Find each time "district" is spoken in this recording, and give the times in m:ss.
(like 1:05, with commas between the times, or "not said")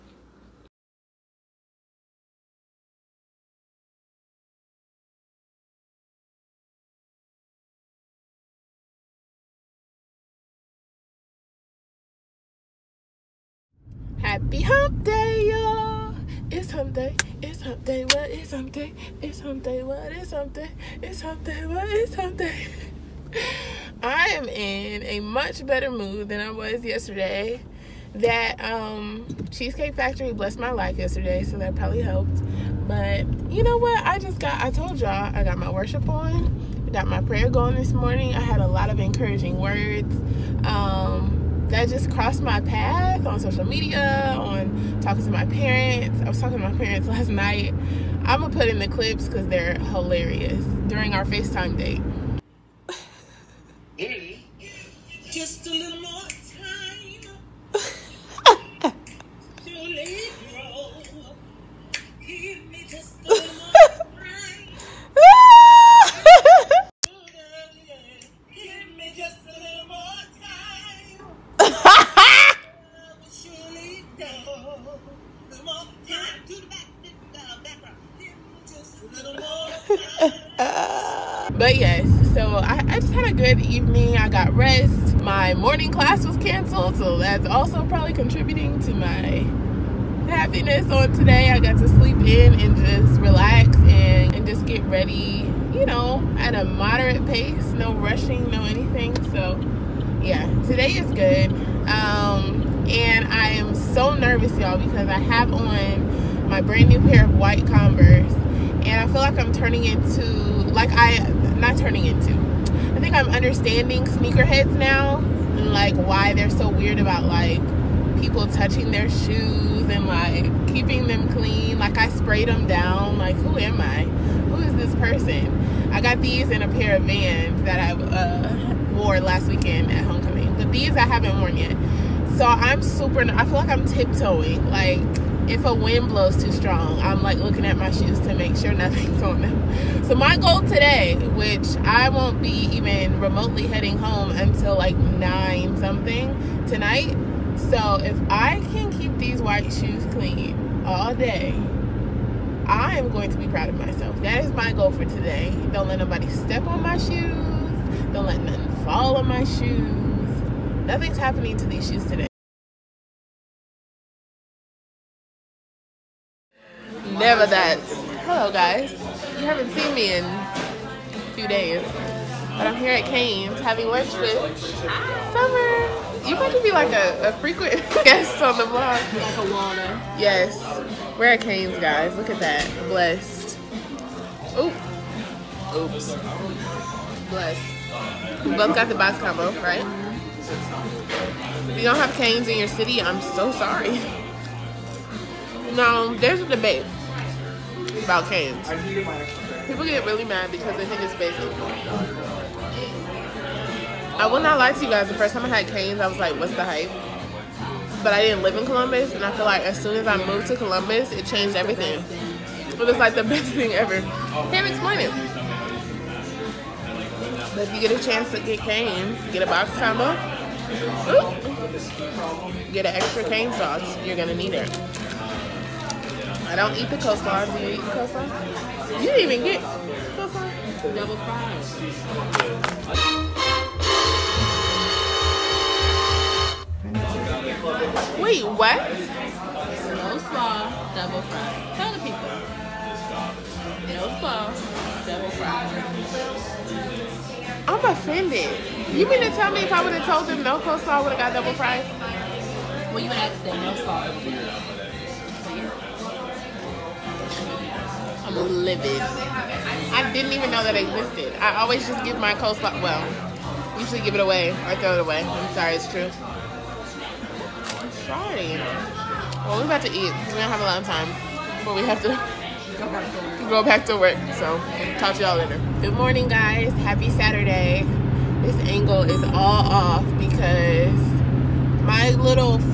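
not said.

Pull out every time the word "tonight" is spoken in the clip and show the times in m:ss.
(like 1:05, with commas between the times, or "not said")
2:26.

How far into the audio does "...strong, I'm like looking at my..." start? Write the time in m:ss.
2:16.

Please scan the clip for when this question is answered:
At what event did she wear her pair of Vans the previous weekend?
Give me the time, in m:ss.
2:10.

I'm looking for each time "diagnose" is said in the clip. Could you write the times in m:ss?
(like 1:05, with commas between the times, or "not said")
not said.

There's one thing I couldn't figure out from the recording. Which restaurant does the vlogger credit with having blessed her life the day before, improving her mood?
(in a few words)
Cheesecake Factory.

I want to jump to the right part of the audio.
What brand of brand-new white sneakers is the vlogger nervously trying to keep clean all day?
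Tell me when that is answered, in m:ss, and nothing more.
1:47.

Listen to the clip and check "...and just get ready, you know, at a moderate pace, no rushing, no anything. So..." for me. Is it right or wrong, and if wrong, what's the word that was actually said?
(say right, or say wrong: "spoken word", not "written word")
right.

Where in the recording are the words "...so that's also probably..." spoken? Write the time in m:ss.
1:26.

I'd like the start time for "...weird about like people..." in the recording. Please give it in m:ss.
1:56.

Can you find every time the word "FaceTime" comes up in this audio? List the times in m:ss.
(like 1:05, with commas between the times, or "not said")
0:51.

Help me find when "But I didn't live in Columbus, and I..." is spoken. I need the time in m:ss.
3:28.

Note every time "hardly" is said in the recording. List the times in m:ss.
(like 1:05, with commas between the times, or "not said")
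not said.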